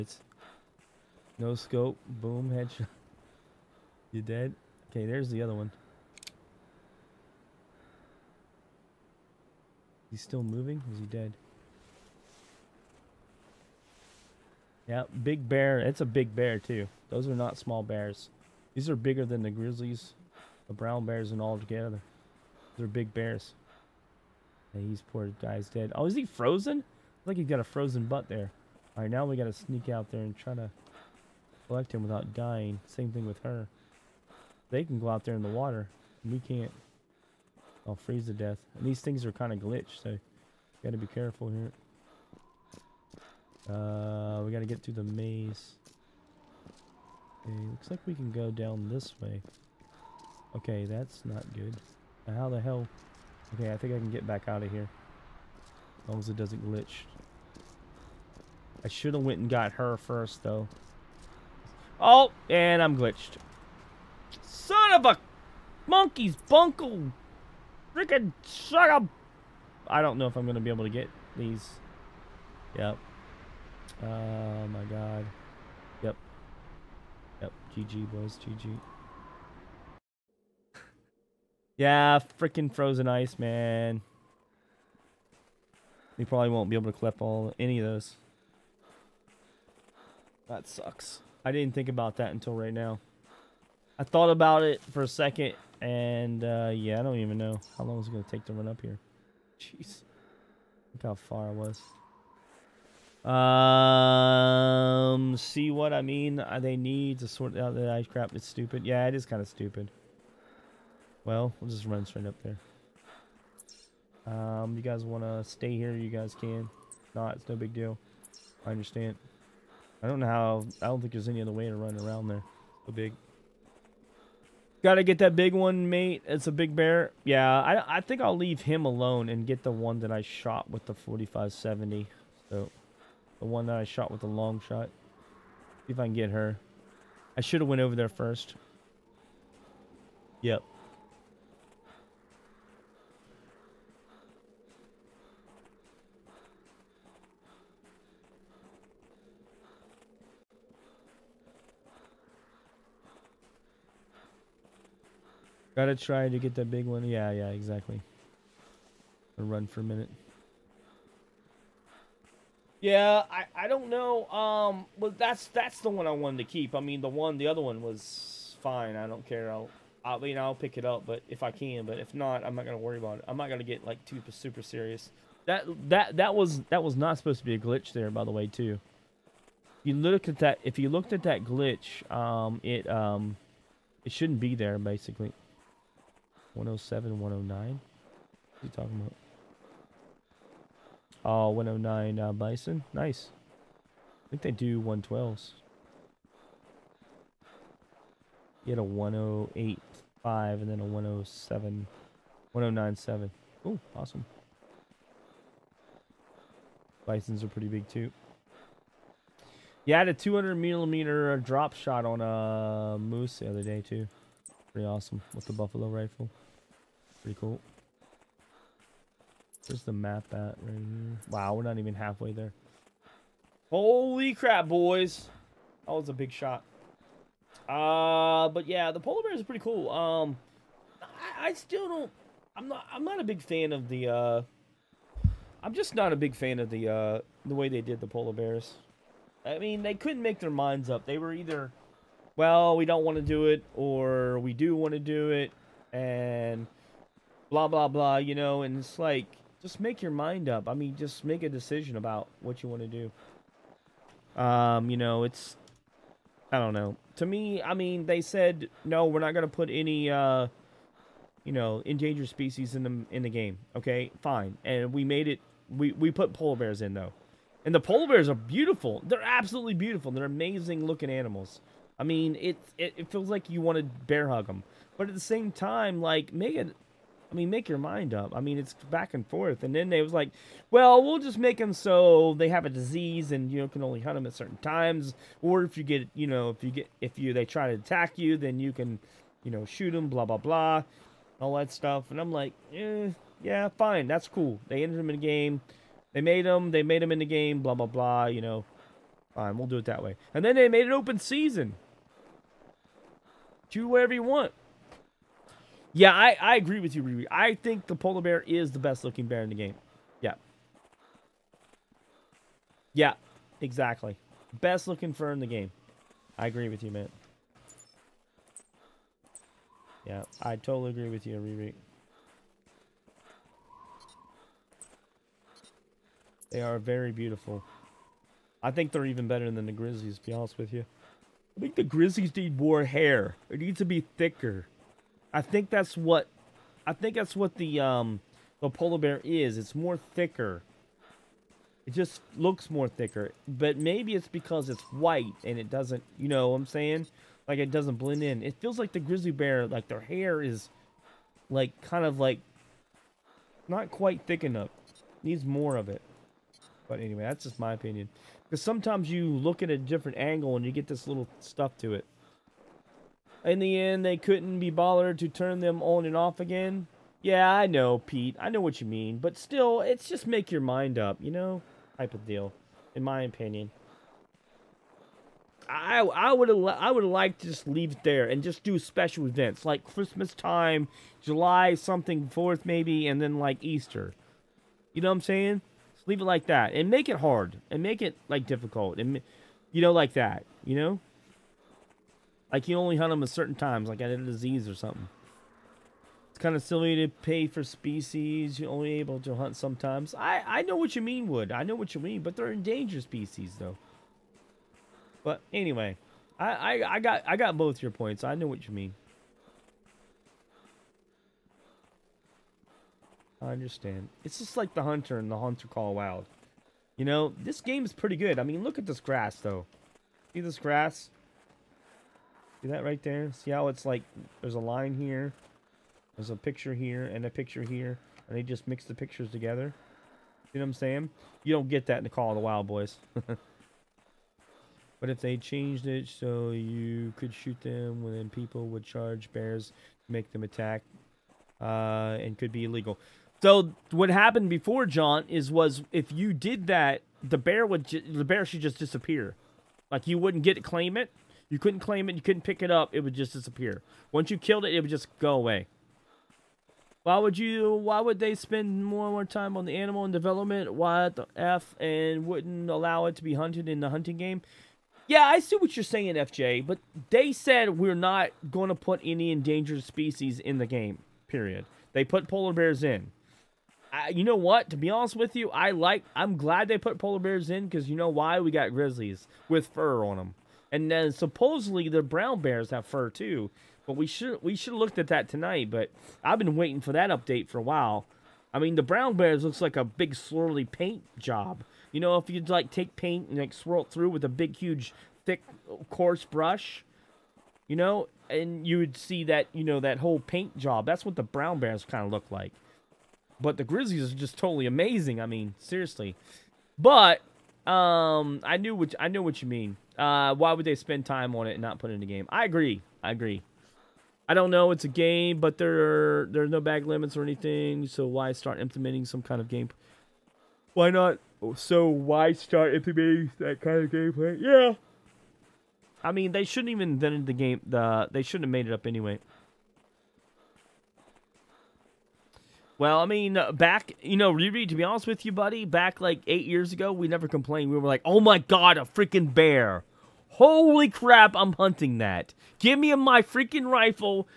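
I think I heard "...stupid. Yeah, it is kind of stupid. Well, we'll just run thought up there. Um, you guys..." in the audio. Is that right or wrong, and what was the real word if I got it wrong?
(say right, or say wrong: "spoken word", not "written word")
wrong: "straight", not "thought".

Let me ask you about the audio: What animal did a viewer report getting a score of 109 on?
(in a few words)
Bison.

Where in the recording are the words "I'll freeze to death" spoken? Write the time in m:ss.
0:37.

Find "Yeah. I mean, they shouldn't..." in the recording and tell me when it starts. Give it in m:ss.
8:44.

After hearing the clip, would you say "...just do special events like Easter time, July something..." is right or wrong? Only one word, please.
wrong.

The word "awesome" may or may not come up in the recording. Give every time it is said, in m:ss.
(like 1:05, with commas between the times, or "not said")
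3:23, 3:34.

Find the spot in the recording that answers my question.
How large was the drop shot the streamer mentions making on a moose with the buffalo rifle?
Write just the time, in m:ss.
3:30.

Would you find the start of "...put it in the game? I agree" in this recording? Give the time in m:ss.
8:31.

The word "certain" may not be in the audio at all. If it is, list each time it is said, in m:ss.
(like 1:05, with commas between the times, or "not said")
4:44, 6:33.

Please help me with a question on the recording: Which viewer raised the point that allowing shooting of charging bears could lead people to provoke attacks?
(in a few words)
John.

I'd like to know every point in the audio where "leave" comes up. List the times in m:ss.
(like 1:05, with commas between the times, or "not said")
2:08, 6:17, 6:26.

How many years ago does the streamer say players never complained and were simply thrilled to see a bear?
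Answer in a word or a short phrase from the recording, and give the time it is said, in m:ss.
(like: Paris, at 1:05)
8, at 8:56.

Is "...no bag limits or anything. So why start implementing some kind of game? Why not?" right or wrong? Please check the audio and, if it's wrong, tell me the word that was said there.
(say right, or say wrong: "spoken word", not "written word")
right.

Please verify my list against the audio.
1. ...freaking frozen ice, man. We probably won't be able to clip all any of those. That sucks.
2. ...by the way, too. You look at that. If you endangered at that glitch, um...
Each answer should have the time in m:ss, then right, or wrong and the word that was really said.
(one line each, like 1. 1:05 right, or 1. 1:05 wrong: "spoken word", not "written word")
1. 1:22 right
2. 2:58 wrong: "looked", not "endangered".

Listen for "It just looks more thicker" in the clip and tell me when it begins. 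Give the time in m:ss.
5:41.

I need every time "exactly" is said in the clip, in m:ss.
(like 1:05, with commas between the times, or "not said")
2:37, 5:13.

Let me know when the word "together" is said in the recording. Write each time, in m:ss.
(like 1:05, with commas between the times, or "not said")
0:21, 7:09.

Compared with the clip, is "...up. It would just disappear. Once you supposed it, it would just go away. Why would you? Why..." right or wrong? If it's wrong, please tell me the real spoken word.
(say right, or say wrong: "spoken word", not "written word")
wrong: "killed", not "supposed".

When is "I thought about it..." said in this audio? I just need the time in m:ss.
1:33.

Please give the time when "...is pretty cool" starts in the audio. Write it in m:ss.
3:49.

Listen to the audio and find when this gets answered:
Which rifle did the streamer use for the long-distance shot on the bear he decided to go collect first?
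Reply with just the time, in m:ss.
2:10.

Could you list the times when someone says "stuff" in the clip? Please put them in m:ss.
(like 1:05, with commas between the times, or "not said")
4:51, 6:01.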